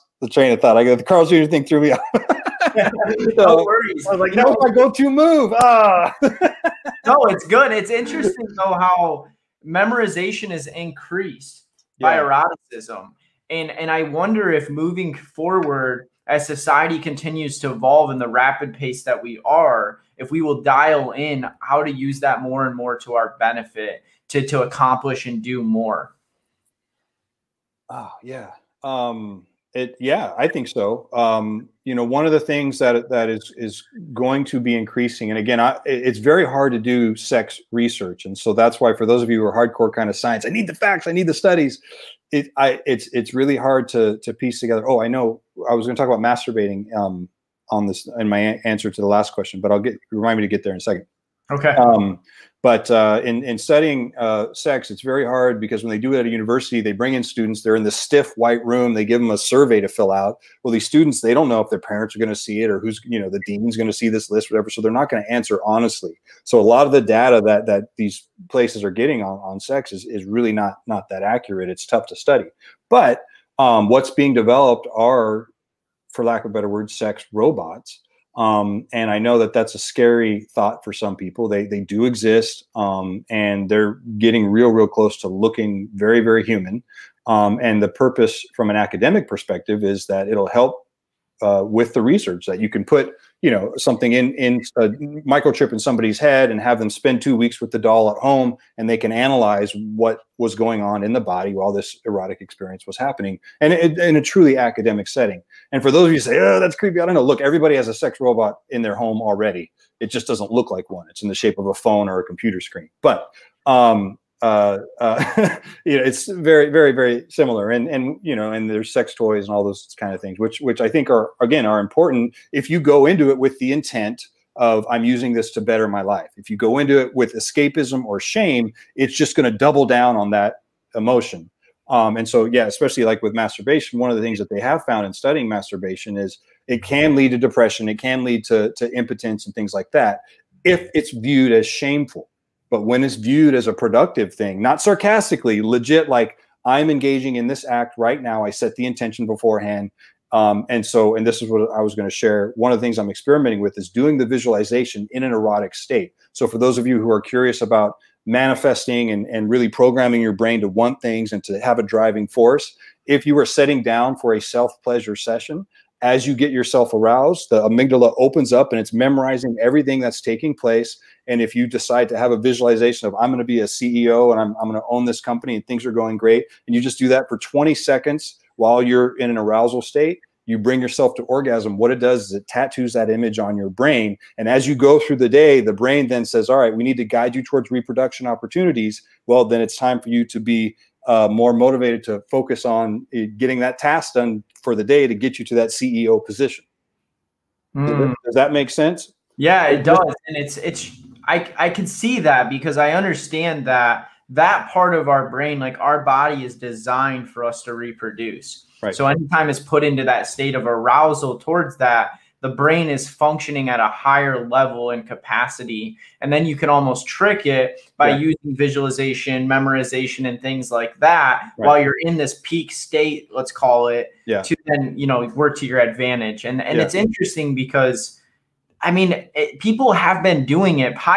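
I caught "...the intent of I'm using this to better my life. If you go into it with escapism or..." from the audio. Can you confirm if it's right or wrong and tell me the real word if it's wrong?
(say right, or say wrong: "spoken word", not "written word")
right.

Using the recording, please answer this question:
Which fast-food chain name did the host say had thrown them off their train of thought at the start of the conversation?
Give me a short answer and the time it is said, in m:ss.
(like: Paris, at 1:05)
Carl Jr., at 0:01.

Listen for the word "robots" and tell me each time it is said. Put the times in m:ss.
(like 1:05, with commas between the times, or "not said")
1:17, 1:48.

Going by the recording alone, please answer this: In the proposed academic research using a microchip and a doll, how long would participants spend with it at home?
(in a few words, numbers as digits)
2 weeks.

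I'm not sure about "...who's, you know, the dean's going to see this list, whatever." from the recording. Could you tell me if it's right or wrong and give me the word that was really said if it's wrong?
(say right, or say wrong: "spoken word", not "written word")
right.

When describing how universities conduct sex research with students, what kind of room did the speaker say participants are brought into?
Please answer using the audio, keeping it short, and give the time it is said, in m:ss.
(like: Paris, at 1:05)
stiff white room, at 0:57.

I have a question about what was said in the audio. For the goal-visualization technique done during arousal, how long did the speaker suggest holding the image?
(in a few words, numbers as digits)
20 seconds.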